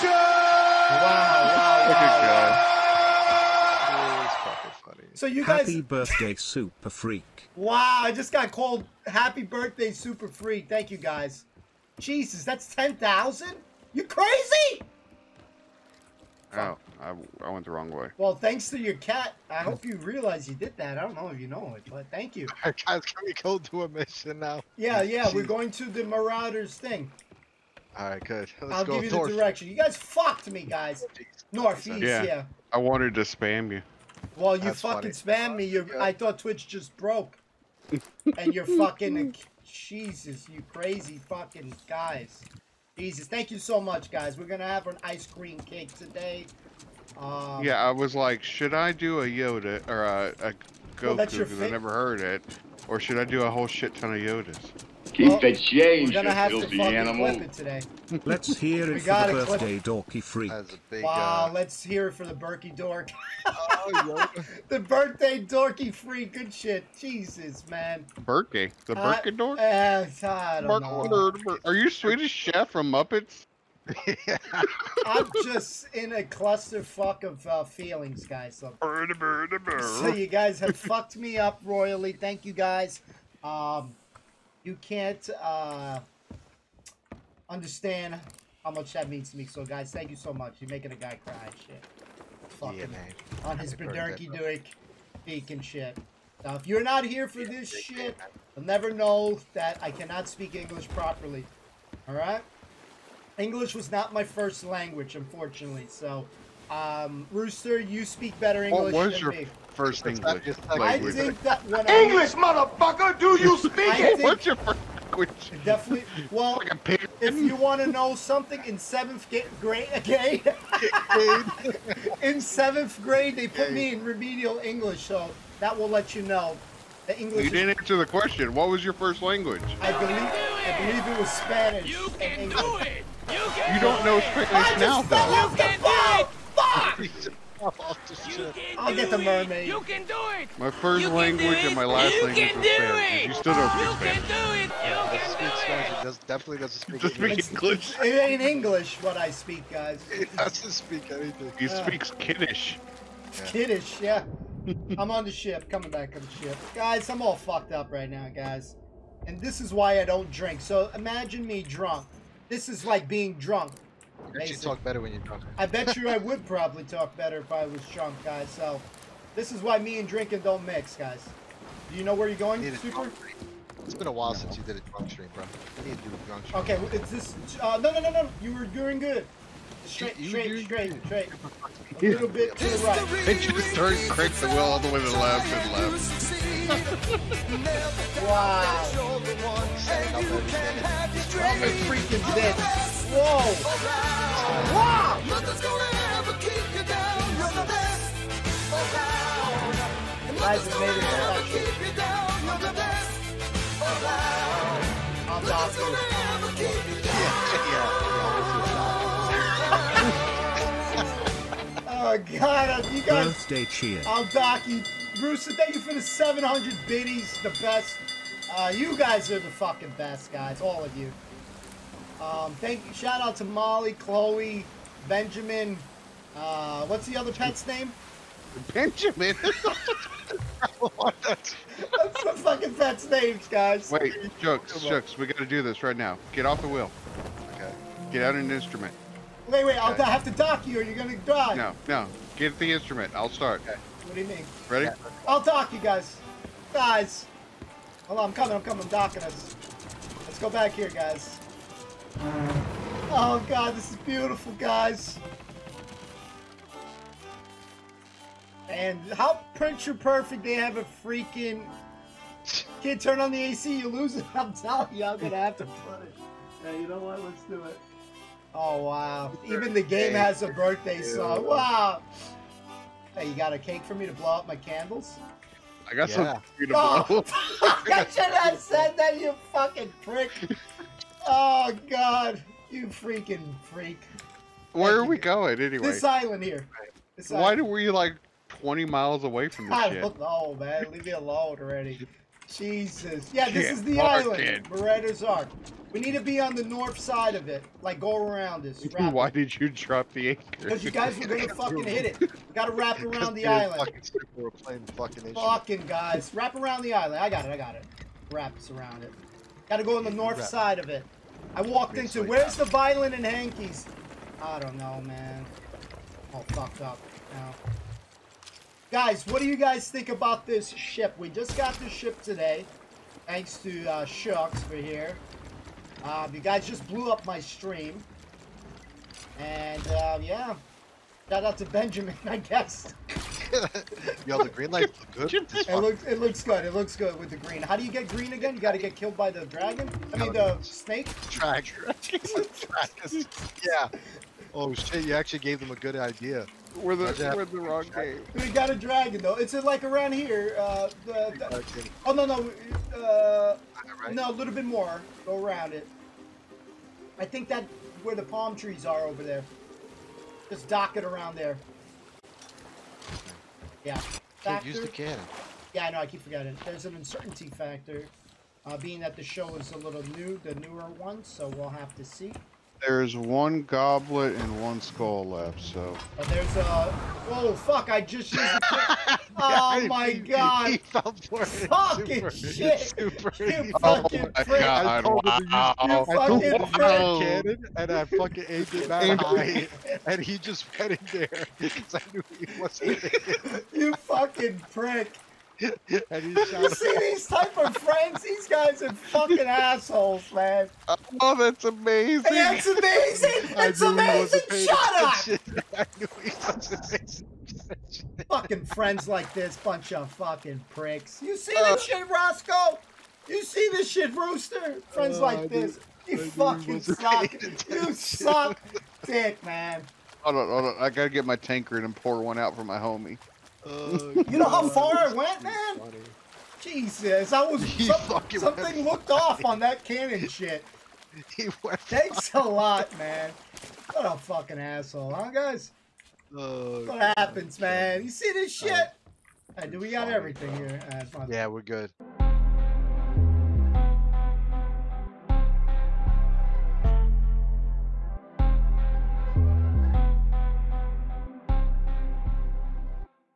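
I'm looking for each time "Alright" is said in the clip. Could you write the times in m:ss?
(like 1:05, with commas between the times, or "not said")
1:42.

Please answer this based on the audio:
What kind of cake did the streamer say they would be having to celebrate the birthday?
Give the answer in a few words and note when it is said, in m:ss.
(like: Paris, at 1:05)
ice cream cake, at 0:45.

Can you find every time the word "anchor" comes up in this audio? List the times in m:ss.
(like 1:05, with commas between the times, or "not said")
5:00.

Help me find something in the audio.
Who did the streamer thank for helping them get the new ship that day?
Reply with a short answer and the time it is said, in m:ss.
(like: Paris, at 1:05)
Shucks, at 5:24.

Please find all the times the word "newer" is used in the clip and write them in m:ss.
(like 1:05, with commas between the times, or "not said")
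6:10.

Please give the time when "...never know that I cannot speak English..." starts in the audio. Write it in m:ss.
1:38.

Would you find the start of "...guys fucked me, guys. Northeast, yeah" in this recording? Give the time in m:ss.
0:29.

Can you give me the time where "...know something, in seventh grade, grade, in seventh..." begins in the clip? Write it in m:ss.
1:57.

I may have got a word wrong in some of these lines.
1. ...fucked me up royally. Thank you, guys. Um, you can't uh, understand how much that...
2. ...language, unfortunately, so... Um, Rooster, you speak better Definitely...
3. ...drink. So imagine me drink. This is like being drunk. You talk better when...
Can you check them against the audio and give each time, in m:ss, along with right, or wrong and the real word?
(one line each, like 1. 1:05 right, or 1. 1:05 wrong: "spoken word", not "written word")
1. 1:20 right
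2. 1:44 wrong: "English", not "Definitely"
3. 2:40 wrong: "drunk", not "drink".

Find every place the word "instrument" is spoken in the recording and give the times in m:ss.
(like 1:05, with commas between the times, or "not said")
3:58, 4:02.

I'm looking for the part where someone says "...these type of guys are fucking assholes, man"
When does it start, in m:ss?
6:36.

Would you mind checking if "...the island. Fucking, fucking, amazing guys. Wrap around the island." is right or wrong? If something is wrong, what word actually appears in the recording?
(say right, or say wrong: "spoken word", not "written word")
wrong: "fucking", not "amazing".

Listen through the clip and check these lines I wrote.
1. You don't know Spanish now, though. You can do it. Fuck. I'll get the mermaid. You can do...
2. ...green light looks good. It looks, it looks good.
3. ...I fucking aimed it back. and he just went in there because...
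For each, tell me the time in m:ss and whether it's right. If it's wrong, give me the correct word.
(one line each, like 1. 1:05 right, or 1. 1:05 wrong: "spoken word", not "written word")
1. 2:13 right
2. 5:34 right
3. 6:27 right.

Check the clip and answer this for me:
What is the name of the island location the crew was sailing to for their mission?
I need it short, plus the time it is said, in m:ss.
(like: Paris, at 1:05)
Marauder's Arch, at 4:54.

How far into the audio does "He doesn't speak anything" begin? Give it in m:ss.
2:30.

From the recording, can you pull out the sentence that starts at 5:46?
We're the, we're the wrong game.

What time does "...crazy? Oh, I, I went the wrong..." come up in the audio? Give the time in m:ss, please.
0:14.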